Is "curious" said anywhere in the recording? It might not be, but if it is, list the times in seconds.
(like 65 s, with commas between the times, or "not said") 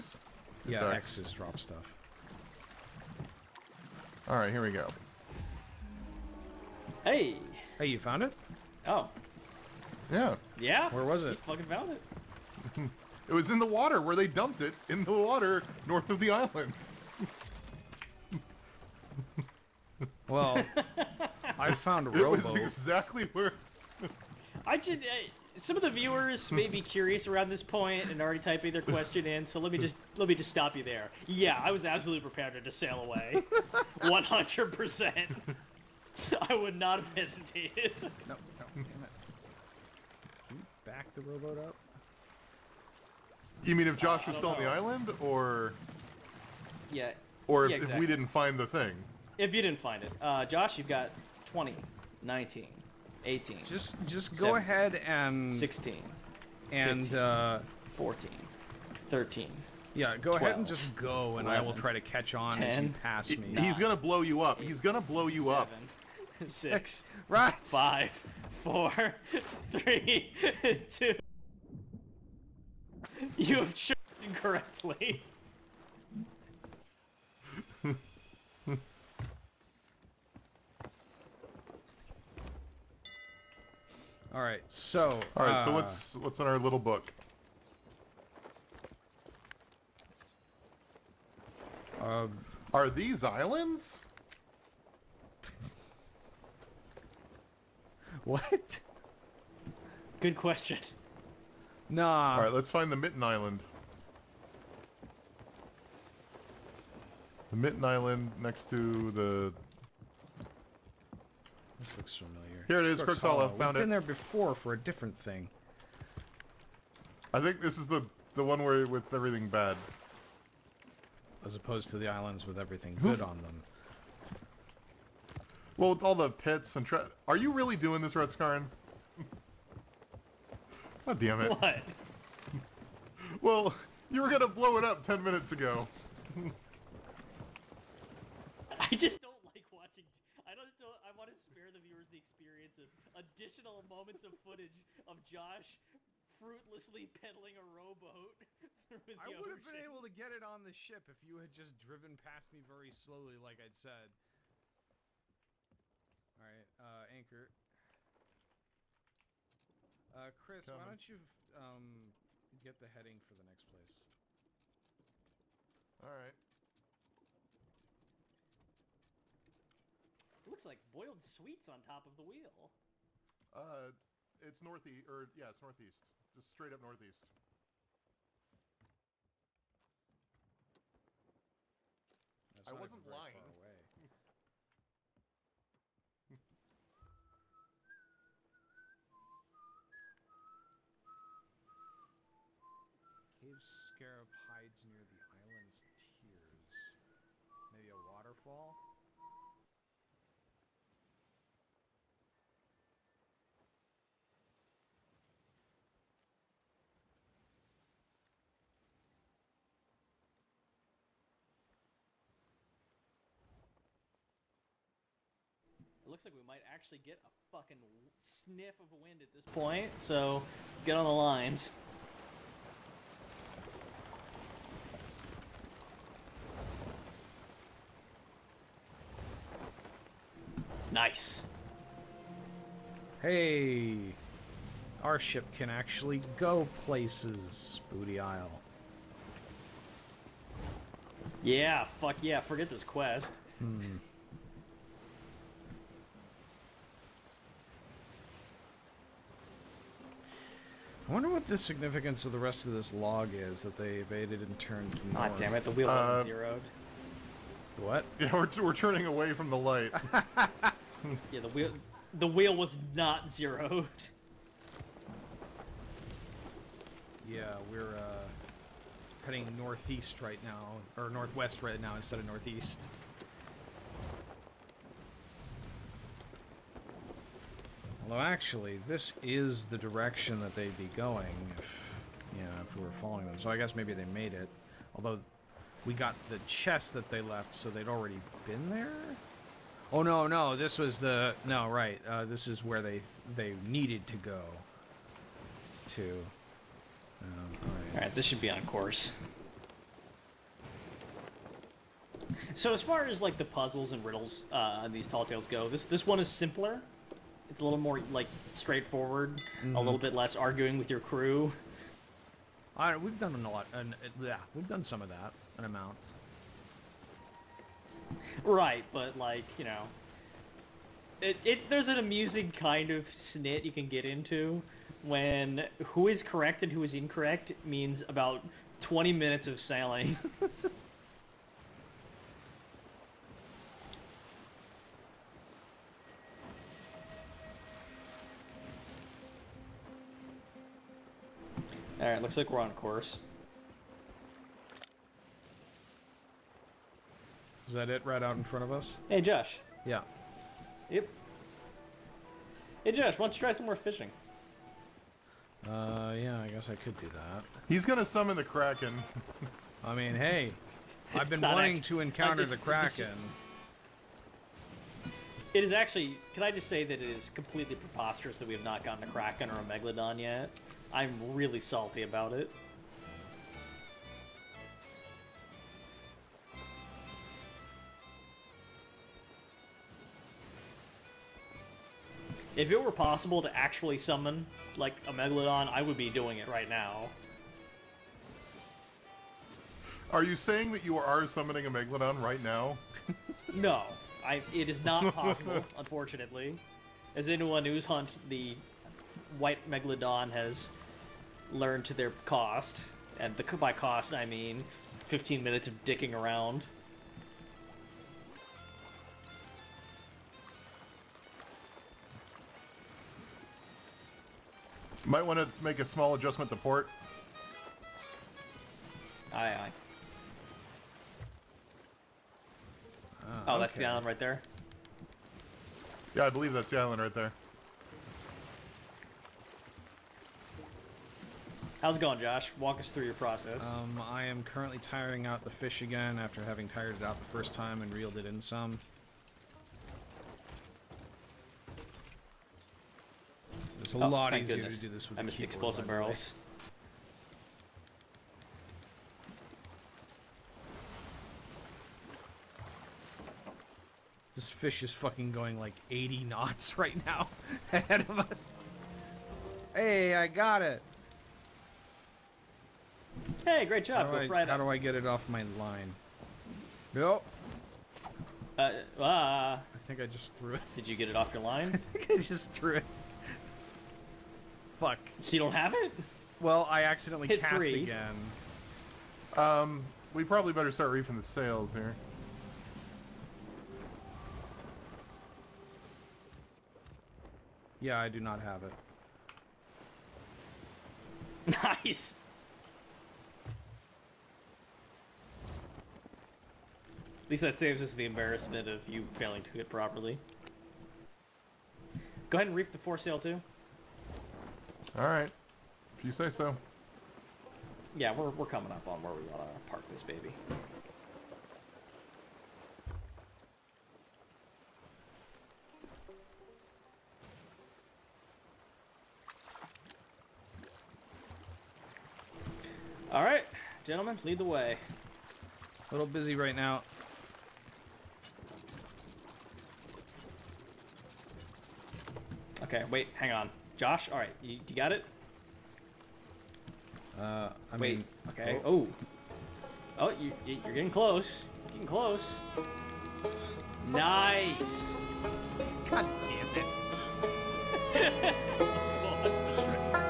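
26 s.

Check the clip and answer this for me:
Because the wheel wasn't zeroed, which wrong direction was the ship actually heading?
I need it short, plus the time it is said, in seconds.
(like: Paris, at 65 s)
Northwest, at 271 s.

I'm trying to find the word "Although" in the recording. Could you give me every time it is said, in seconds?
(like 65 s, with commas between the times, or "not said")
278 s, 284 s.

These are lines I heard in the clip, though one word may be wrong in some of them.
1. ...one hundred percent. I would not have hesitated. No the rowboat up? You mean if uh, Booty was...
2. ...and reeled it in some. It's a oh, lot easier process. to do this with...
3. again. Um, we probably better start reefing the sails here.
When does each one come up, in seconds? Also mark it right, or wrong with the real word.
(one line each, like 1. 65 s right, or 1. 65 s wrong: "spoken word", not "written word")
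1. 34 s wrong: "Josh", not "Booty"
2. 437 s wrong: "goodness", not "process"
3. 477 s right.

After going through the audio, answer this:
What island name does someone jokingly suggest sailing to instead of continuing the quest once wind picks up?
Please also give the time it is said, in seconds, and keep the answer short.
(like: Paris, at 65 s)
Booty Isle, at 237 s.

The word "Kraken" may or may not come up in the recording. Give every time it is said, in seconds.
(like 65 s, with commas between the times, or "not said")
358 s, 362 s, 369 s.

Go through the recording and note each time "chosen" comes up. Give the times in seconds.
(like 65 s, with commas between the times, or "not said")
73 s.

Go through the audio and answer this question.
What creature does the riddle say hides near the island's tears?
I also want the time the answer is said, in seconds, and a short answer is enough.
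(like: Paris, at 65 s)
Cave Scarab, at 193 s.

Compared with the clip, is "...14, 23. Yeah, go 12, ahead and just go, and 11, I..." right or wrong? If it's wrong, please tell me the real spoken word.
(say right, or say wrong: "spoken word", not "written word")
wrong: "13", not "23".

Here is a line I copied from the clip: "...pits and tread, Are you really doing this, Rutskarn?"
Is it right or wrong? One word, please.
right.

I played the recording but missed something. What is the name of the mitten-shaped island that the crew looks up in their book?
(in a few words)
Crooks Hollow.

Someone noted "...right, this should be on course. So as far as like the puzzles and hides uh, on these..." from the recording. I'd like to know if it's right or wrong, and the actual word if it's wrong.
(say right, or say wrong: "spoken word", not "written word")
wrong: "riddles", not "hides".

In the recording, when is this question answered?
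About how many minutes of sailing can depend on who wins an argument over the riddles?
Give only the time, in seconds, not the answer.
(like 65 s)
328 s.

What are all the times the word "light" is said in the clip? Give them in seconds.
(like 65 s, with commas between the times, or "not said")
259 s.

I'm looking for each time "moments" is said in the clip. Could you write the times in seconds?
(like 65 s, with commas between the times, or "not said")
143 s.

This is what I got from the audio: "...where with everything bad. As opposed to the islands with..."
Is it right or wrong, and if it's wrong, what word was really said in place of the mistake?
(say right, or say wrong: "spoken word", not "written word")
right.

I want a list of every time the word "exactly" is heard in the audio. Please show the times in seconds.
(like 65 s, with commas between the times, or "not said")
22 s, 47 s.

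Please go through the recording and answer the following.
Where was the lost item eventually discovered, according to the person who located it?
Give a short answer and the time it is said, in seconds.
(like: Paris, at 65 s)
In the water north of the island, at 13 s.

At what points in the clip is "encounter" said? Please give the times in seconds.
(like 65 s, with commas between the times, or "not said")
362 s.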